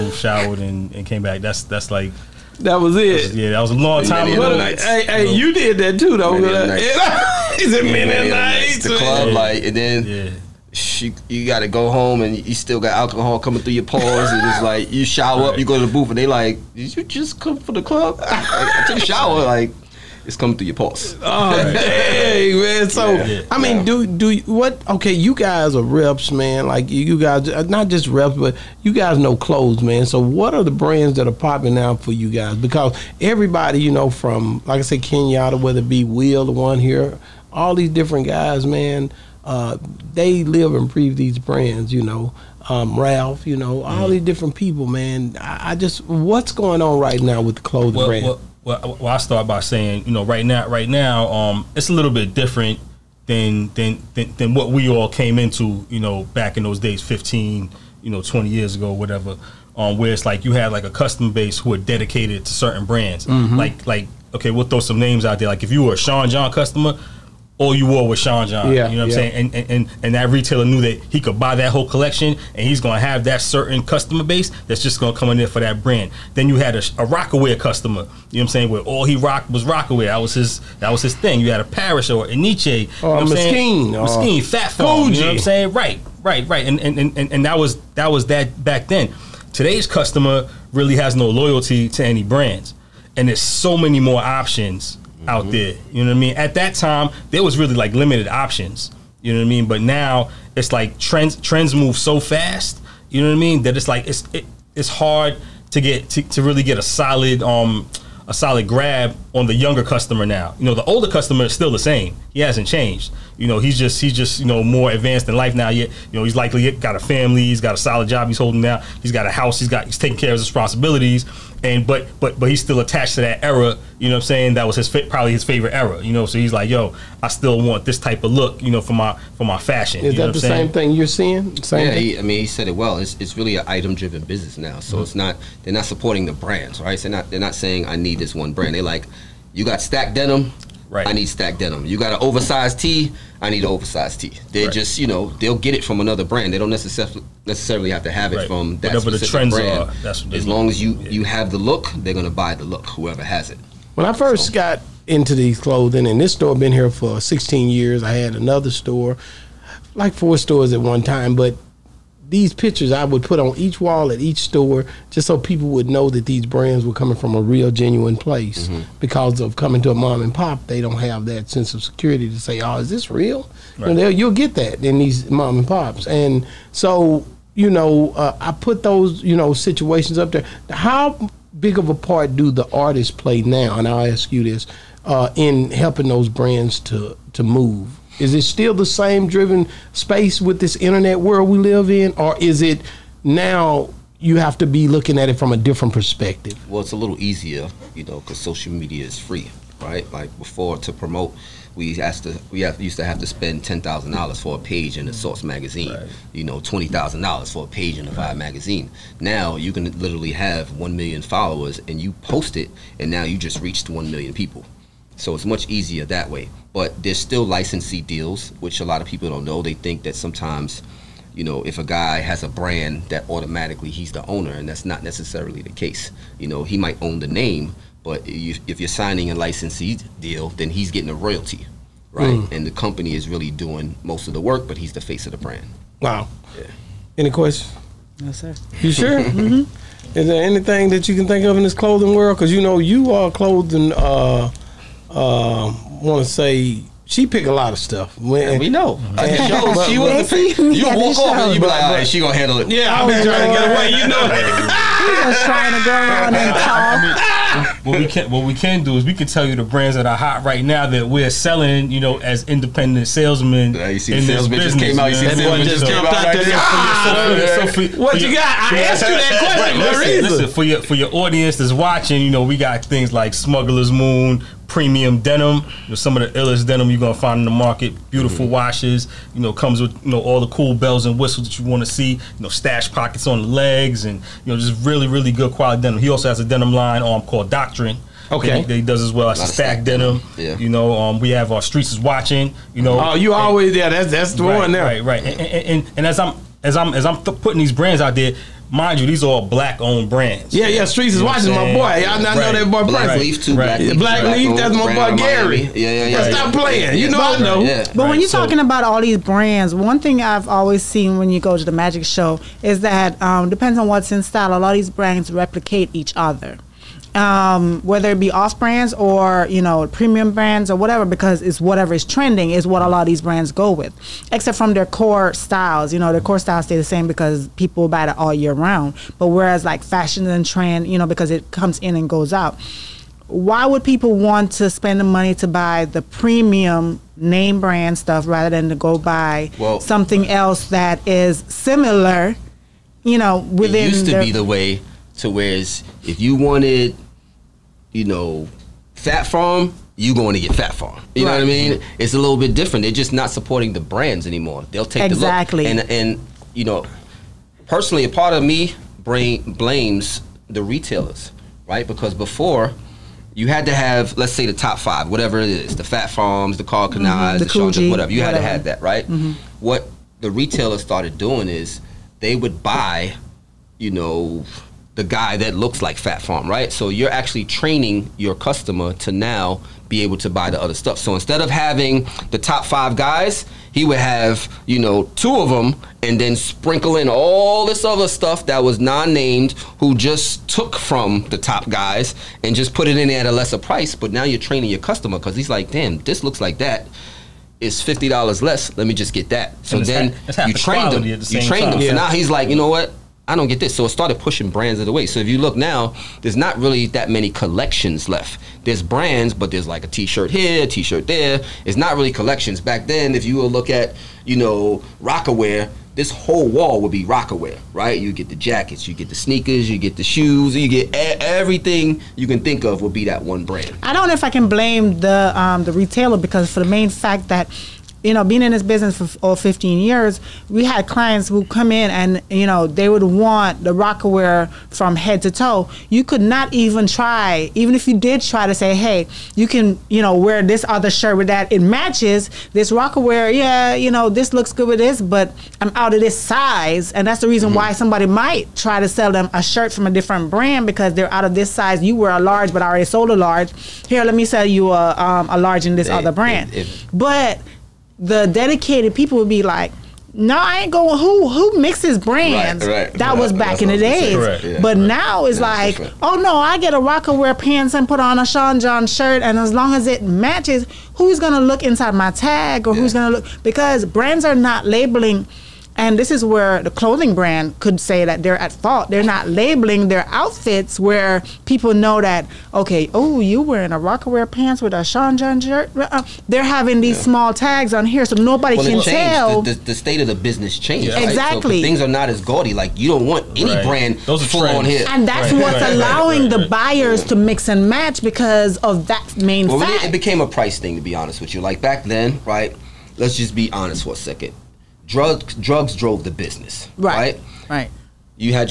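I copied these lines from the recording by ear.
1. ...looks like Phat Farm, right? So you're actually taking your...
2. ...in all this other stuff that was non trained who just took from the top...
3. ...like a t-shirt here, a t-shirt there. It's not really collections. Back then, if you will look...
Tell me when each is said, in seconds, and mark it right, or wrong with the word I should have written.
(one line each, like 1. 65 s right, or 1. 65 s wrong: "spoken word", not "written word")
1. 375 s wrong: "training", not "taking"
2. 386 s wrong: "named", not "trained"
3. 409 s right.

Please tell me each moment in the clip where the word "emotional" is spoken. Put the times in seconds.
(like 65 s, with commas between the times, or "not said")
not said.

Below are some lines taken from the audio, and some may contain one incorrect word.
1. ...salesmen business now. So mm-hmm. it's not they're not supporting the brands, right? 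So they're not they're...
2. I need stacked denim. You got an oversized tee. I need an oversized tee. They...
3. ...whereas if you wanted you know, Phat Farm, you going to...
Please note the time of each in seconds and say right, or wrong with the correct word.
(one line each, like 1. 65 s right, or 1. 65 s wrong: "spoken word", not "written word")
1. 133 s wrong: "driven", not "salesmen"
2. 141 s right
3. 345 s right.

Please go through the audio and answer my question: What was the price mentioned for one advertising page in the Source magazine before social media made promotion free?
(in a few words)
$10,000.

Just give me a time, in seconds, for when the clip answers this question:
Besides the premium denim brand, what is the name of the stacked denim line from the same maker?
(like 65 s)
287 s.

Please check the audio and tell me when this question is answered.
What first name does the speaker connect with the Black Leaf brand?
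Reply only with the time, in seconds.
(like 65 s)
305 s.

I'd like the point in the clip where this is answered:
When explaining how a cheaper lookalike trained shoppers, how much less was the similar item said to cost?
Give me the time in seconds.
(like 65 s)
397 s.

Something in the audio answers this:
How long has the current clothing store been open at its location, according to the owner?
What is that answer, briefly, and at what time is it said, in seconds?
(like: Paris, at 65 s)
16 years, at 157 s.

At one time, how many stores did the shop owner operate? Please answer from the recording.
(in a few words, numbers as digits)
4.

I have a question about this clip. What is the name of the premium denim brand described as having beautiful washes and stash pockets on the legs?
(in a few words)
Smuggler's Moon.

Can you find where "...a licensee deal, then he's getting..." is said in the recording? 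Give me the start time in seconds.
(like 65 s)
229 s.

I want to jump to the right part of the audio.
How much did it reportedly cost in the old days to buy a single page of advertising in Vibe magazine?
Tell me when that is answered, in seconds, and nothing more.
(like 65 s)
206 s.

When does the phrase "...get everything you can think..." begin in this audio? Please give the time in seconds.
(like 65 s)
420 s.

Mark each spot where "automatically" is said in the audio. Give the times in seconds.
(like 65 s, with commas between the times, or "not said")
223 s.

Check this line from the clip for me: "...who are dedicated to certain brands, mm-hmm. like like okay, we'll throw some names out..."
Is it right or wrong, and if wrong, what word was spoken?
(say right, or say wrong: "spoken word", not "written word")
right.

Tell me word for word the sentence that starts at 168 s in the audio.
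because of coming to a mom and pop they don't have that sense of security to say oh is this real right.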